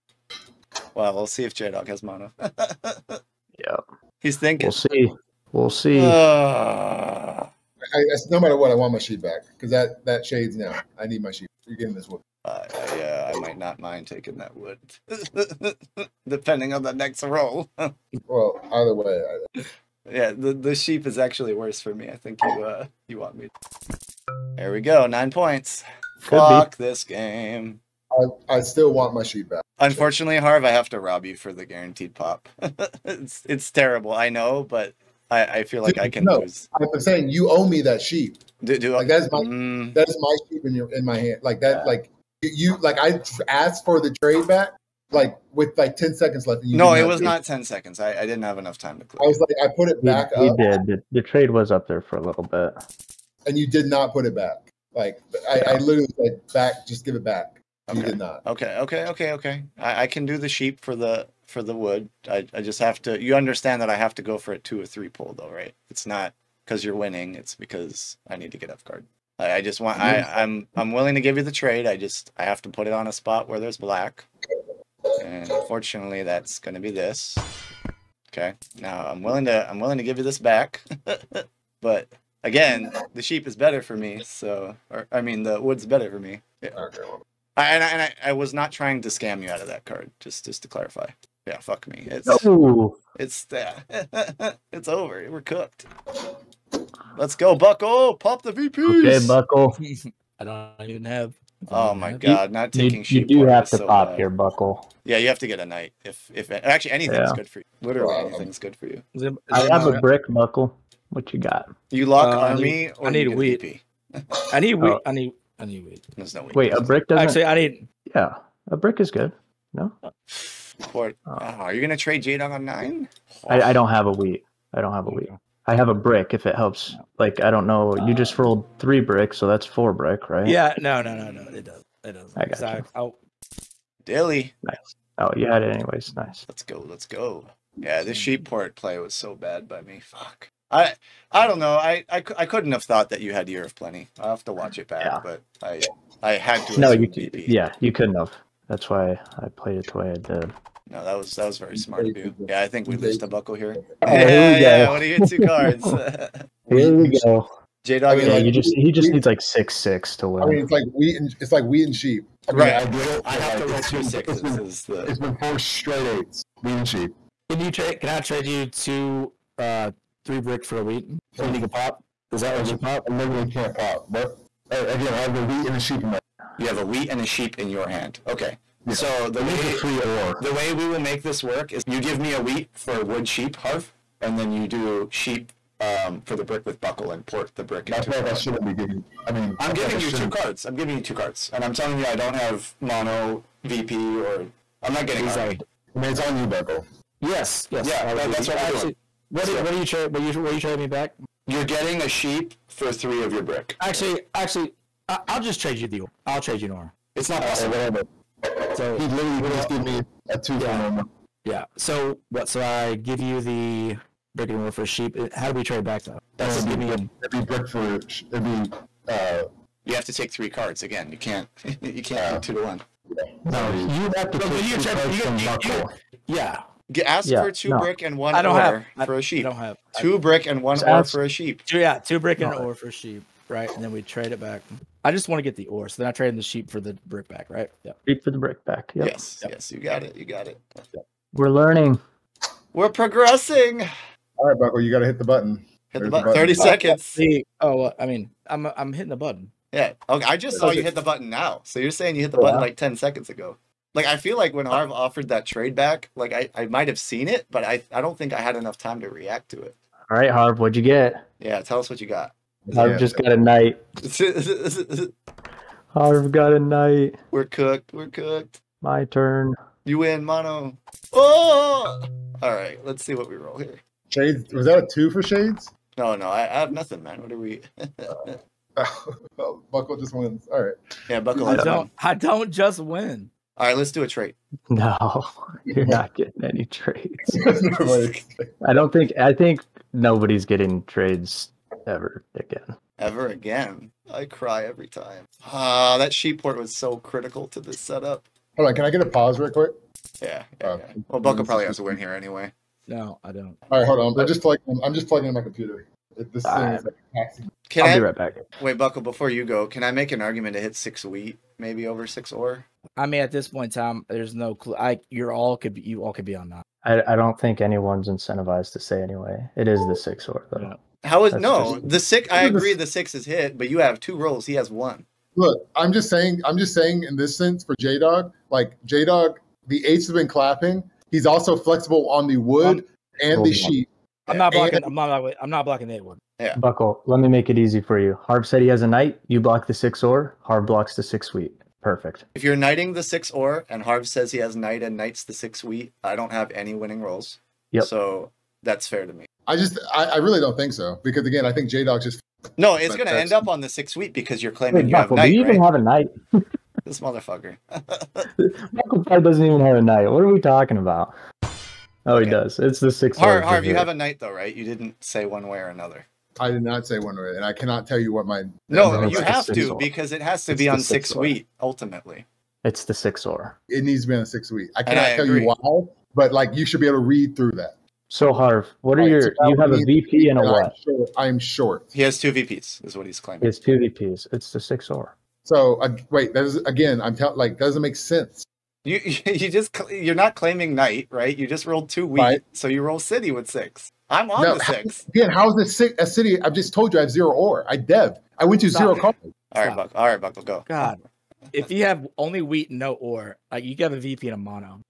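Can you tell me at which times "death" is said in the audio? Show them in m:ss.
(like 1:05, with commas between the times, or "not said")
not said.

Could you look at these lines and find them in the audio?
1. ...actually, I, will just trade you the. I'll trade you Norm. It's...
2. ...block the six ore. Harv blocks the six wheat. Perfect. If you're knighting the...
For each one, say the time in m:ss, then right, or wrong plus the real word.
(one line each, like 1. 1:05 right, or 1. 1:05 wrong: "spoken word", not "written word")
1. 3:24 right
2. 5:39 right.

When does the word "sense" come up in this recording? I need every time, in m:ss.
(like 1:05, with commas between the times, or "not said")
5:27, 6:27.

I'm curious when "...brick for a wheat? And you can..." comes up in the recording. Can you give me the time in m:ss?
2:50.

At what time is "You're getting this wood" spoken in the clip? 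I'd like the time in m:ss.
0:11.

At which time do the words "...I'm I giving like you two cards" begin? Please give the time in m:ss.
3:09.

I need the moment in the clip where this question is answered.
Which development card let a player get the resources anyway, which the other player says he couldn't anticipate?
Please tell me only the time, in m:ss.
2:23.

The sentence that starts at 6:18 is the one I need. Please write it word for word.
So Harv, what right, are your?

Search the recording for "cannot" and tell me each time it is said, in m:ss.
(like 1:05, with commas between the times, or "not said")
6:07, 6:14.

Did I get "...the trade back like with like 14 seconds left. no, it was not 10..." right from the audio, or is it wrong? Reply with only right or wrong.
wrong.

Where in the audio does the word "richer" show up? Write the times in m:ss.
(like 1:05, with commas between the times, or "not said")
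not said.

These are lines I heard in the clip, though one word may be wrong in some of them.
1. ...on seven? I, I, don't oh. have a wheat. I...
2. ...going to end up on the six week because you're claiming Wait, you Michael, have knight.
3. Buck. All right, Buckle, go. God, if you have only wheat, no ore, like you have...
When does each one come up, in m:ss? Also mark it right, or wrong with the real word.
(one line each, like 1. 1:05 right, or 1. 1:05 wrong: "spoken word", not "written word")
1. 2:02 wrong: "nine", not "seven"
2. 5:52 right
3. 6:39 right.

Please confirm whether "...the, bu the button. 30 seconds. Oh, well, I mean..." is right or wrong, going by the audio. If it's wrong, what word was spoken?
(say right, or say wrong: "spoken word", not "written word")
right.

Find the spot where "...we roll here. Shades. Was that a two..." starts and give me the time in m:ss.
4:33.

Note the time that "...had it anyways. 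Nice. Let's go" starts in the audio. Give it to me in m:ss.
2:15.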